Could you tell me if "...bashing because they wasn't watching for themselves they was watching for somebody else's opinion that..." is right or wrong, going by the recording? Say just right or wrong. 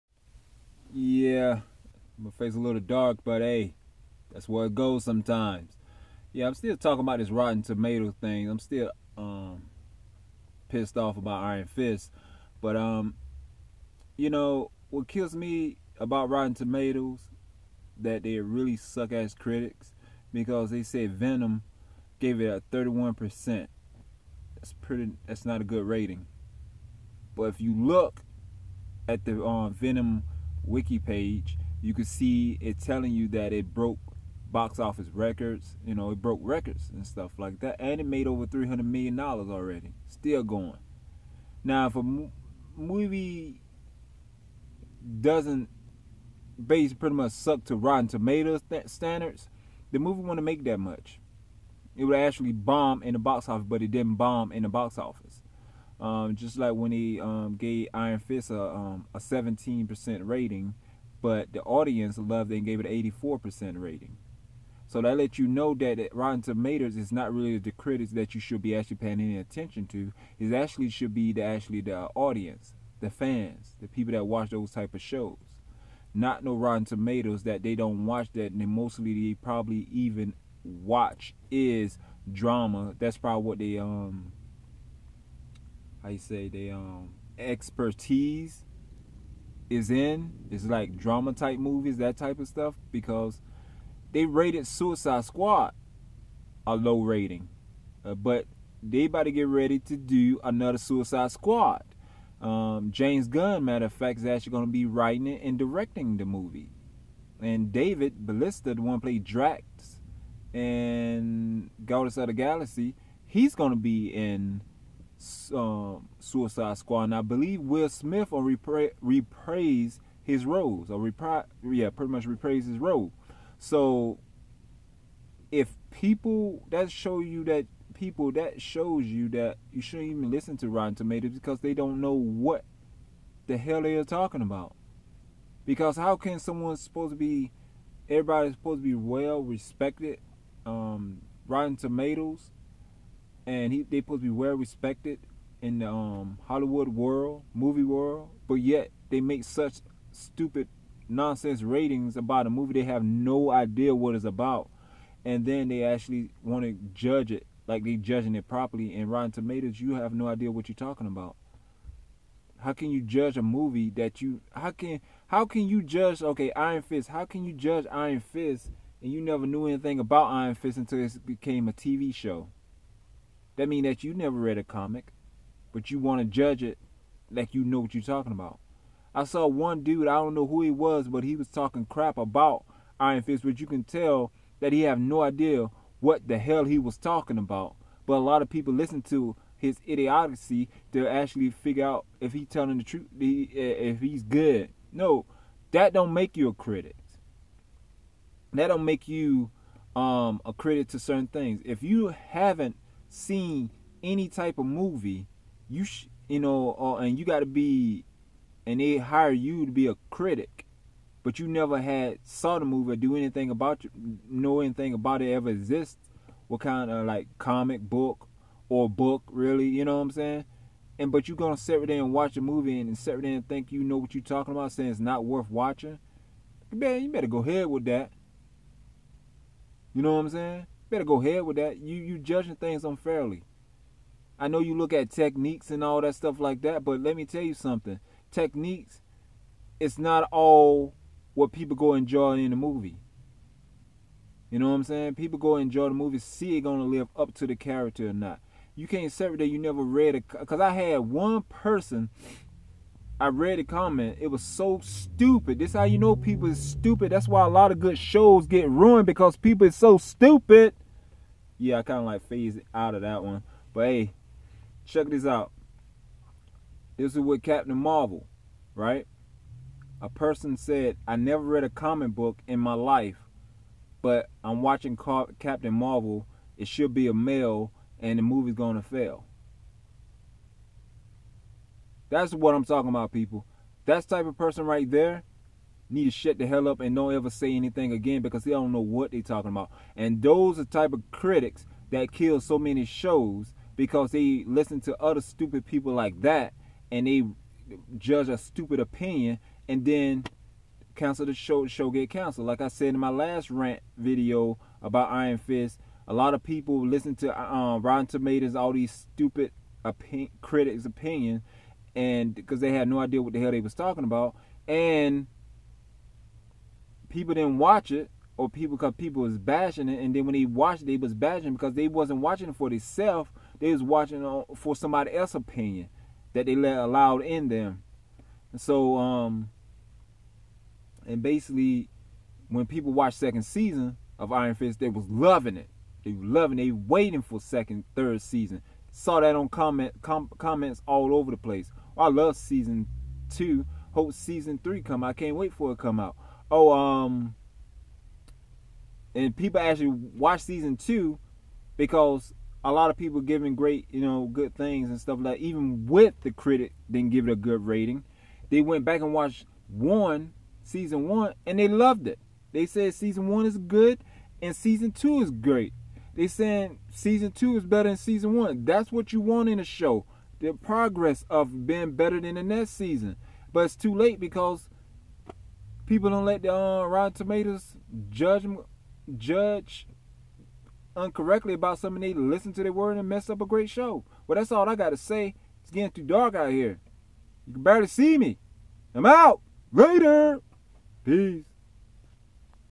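right.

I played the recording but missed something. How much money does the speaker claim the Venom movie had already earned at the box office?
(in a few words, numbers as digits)
over 300 million dollars.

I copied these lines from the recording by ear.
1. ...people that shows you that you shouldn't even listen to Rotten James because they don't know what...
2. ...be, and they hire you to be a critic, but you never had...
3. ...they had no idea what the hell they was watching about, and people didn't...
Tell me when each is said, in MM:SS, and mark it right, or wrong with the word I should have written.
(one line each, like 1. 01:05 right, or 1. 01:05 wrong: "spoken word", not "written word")
1. 02:07 wrong: "Tomatoes", not "James"
2. 03:27 right
3. 05:12 wrong: "talking", not "watching".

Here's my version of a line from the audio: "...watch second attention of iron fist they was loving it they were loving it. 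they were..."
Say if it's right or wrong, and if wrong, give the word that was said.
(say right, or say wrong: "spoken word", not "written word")
wrong: "season", not "attention".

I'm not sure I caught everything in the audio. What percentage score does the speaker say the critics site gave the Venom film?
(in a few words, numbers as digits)
31%.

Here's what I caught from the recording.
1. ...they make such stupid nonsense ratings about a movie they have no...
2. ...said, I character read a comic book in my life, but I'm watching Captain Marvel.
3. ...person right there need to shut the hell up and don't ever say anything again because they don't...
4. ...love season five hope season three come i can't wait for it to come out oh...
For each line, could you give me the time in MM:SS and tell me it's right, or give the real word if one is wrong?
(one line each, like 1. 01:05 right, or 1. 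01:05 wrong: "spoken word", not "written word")
1. 02:29 right
2. 04:30 wrong: "never", not "character"
3. 04:44 right
4. 05:42 wrong: "two", not "five".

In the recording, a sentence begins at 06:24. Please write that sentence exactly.
Well, that's all I got to say.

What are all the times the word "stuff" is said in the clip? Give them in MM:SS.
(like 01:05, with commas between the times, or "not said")
00:37, 01:32, 03:56, 05:54.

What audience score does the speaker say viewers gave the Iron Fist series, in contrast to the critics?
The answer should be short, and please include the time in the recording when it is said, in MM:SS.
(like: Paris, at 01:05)
84%, at 01:03.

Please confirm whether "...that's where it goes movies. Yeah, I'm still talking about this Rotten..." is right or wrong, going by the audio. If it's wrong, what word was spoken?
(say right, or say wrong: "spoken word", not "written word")
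wrong: "sometimes", not "movies".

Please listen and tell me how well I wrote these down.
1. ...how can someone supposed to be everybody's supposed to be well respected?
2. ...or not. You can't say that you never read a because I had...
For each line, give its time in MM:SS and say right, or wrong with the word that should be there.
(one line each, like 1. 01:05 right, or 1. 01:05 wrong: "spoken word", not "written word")
1. 02:15 right
2. 04:08 right.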